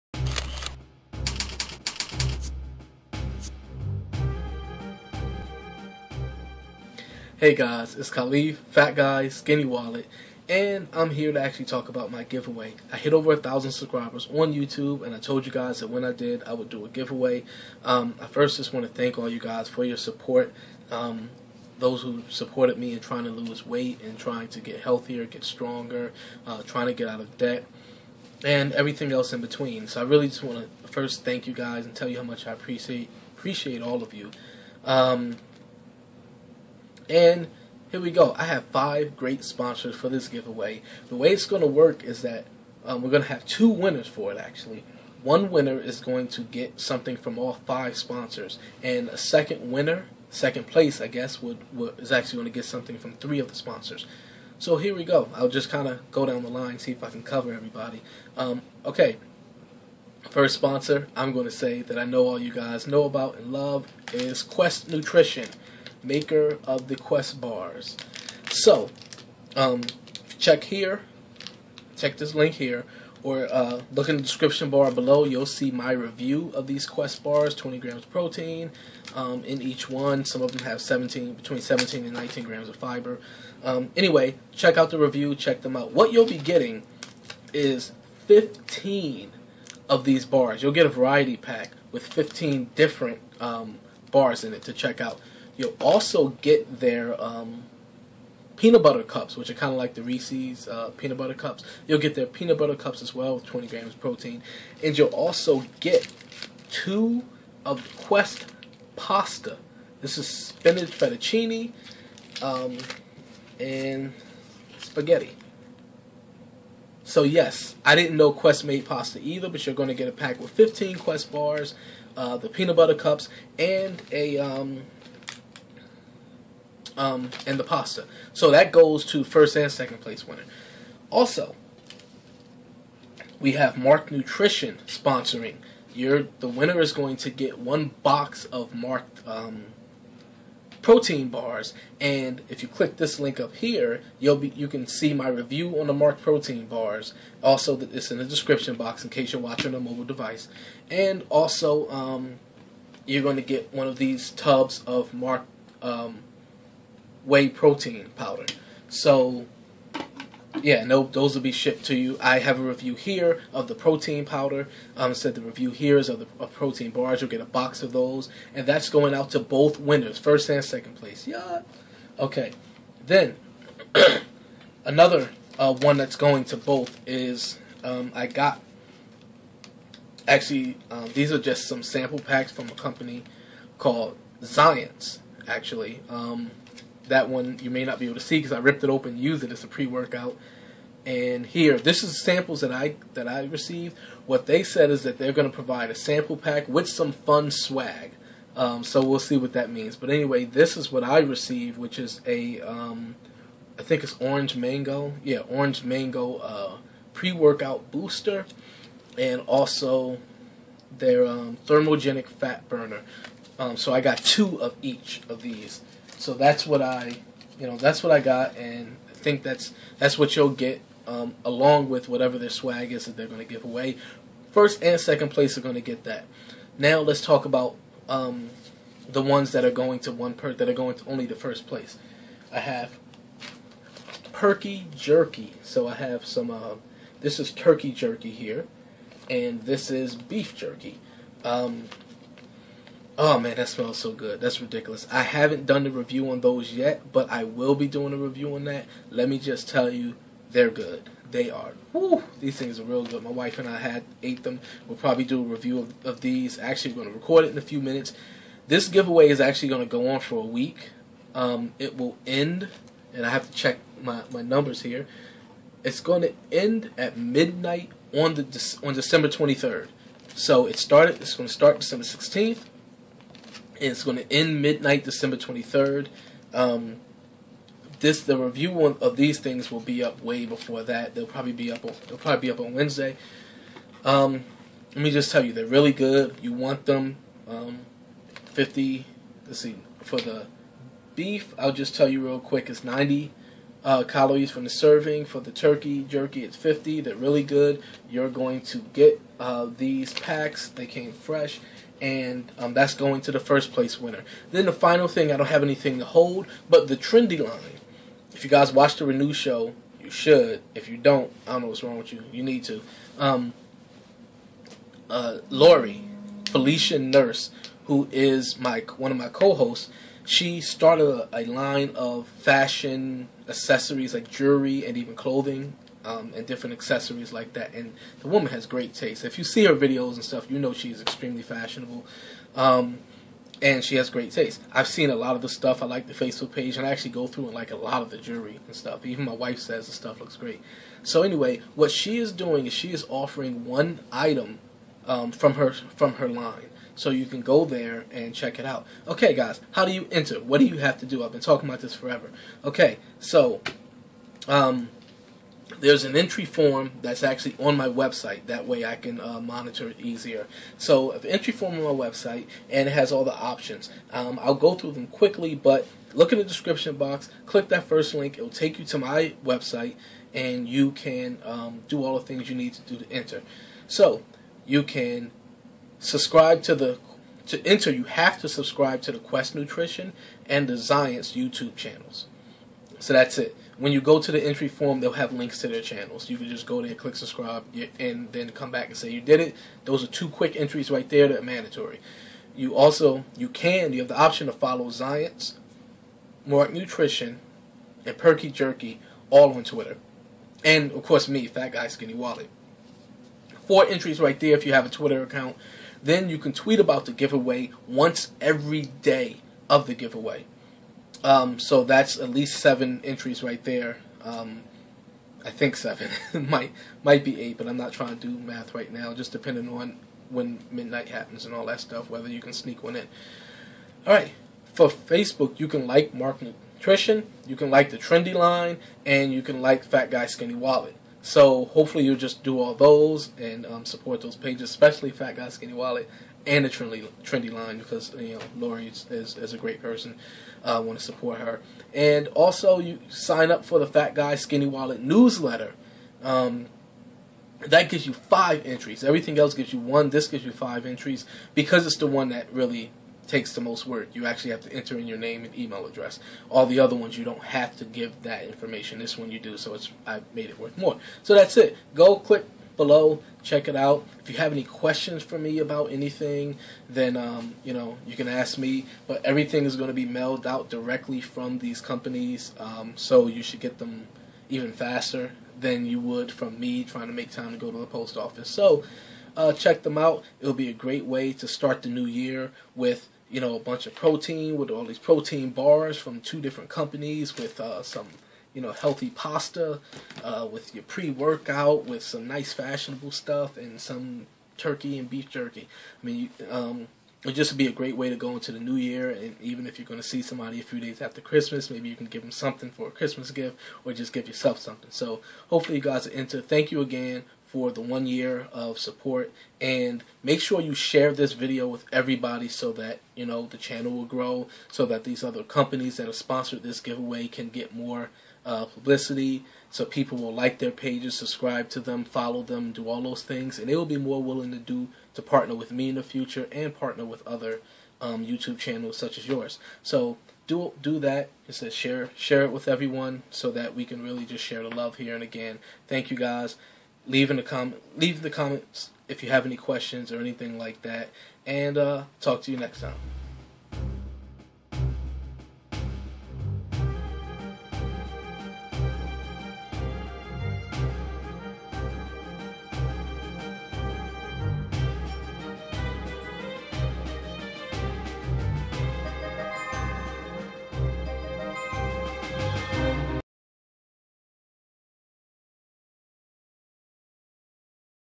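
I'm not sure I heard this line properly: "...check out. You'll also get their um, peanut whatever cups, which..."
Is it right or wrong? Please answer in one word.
wrong.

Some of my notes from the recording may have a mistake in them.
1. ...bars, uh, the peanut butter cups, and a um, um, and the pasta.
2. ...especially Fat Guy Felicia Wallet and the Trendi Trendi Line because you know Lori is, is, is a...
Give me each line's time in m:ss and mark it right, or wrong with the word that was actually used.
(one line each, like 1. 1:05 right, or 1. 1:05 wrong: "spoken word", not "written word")
1. 2:01 right
2. 7:14 wrong: "Skinny", not "Felicia".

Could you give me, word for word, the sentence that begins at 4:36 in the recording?
Um, this the review of these things will be up way before that.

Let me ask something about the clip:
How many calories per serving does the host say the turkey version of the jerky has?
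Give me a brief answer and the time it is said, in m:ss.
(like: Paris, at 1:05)
50, at 4:55.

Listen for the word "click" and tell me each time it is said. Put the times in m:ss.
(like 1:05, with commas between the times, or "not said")
2:22, 6:07, 6:26, 7:42.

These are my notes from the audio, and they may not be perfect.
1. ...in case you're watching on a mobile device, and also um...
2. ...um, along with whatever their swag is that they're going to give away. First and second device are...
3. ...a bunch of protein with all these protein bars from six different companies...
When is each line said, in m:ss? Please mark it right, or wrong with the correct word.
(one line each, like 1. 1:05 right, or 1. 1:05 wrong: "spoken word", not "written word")
1. 2:29 right
2. 3:41 wrong: "place", not "device"
3. 8:03 wrong: "two", not "six".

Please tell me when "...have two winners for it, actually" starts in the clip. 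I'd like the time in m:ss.
0:43.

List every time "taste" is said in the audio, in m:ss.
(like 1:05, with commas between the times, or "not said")
5:28, 5:34.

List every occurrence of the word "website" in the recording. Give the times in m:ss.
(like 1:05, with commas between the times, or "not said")
5:57, 6:02, 6:09.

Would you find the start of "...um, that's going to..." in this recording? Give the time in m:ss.
5:02.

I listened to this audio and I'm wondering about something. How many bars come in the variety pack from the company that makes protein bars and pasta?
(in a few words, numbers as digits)
15.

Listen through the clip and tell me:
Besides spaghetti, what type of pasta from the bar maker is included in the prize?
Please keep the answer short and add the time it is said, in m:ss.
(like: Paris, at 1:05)
spinach fettuccine, at 1:50.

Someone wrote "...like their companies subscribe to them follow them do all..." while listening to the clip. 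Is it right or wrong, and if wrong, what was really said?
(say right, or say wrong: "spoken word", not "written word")
wrong: "pages", not "companies".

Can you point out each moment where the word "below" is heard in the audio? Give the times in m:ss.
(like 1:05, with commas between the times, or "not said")
1:14, 7:42.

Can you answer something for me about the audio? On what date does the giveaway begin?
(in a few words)
December 16th.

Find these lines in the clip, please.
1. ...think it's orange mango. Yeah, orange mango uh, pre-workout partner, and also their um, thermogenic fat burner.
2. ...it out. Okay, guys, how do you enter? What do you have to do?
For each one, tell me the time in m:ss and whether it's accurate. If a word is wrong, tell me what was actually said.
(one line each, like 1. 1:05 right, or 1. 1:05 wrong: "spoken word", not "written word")
1. 3:23 wrong: "booster", not "partner"
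2. 5:48 right.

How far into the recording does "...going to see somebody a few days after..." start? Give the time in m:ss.
8:19.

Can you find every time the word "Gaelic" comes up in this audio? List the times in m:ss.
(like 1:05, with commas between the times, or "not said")
not said.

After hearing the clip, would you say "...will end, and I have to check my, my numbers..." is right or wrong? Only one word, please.
right.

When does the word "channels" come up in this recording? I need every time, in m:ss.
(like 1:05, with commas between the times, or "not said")
6:21, 6:25, 8:33, 8:48.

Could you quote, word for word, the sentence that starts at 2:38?
So, yeah, no, those will be shipped to you.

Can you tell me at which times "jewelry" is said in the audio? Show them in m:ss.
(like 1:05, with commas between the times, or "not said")
5:24, 5:38.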